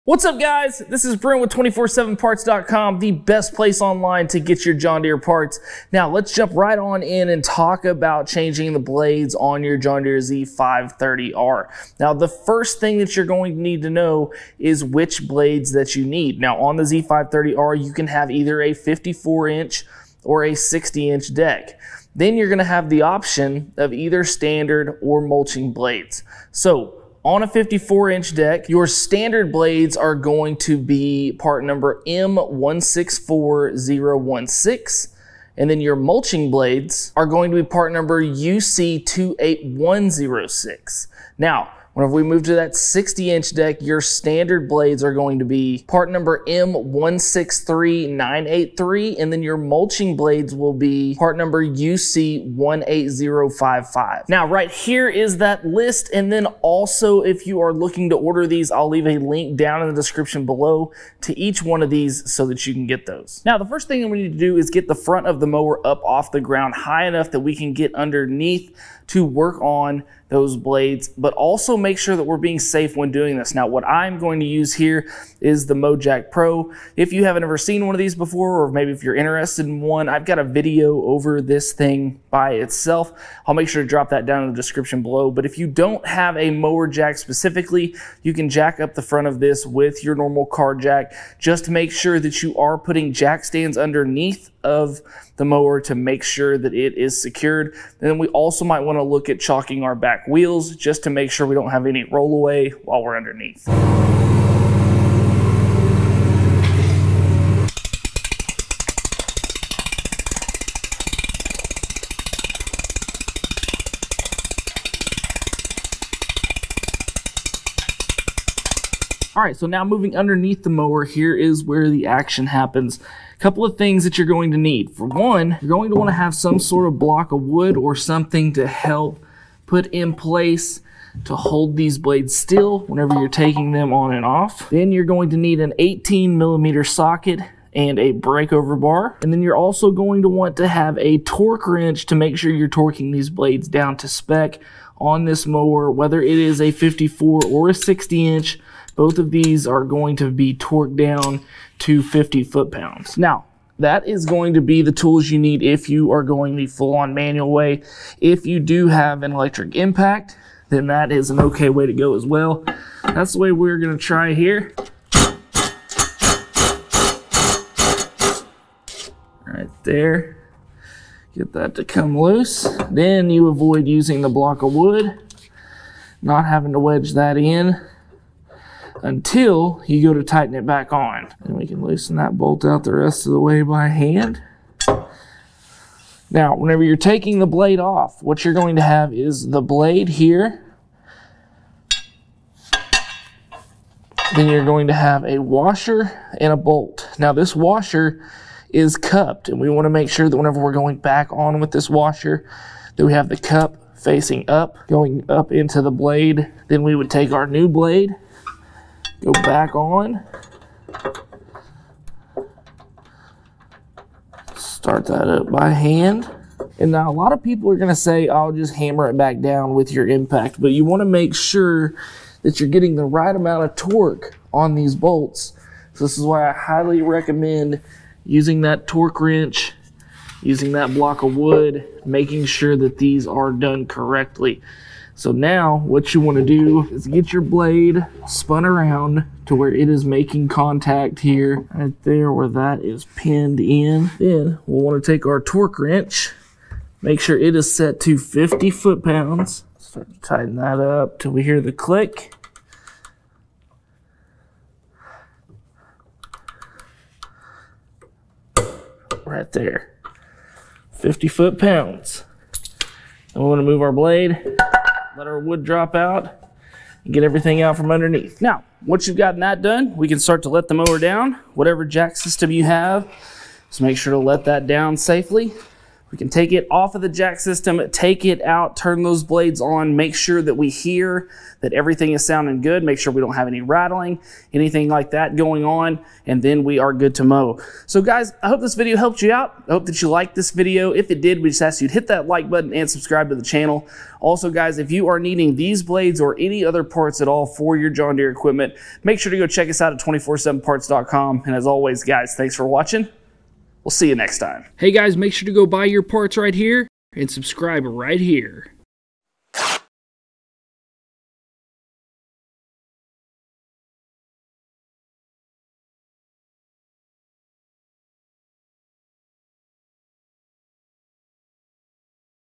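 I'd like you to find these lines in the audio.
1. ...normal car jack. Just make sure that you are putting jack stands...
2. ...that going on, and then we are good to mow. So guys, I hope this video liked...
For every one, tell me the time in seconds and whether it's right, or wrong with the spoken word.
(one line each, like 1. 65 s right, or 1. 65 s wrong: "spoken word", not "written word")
1. 90 s right
2. 285 s wrong: "helped", not "liked".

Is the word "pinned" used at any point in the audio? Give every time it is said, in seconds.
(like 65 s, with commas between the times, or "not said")
243 s.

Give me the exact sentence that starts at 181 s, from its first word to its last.
And we can loosen that bolt out the rest of the way by hand.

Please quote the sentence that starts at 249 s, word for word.
Start to tighten that up till we hear the click.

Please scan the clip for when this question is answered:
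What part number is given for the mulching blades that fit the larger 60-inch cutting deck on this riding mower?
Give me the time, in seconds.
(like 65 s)
51 s.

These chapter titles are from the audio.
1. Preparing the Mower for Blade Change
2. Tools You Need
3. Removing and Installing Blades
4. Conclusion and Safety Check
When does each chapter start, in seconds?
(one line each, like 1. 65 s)
1. 63 s
2. 119 s
3. 163 s
4. 269 s.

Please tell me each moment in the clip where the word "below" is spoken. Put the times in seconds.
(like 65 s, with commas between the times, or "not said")
60 s, 85 s.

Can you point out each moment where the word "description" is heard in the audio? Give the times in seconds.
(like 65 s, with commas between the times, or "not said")
60 s, 84 s.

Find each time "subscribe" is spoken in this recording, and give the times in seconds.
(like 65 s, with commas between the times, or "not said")
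292 s, 307 s.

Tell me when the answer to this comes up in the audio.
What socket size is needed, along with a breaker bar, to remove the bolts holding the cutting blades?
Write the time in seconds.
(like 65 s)
135 s.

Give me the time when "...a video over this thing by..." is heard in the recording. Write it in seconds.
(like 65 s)
80 s.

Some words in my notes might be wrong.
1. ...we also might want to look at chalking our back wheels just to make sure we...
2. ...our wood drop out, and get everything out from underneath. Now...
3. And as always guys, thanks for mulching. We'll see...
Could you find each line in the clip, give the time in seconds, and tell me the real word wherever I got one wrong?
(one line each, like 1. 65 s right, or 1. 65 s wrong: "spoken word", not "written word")
1. 98 s right
2. 265 s right
3. 301 s wrong: "watching", not "mulching".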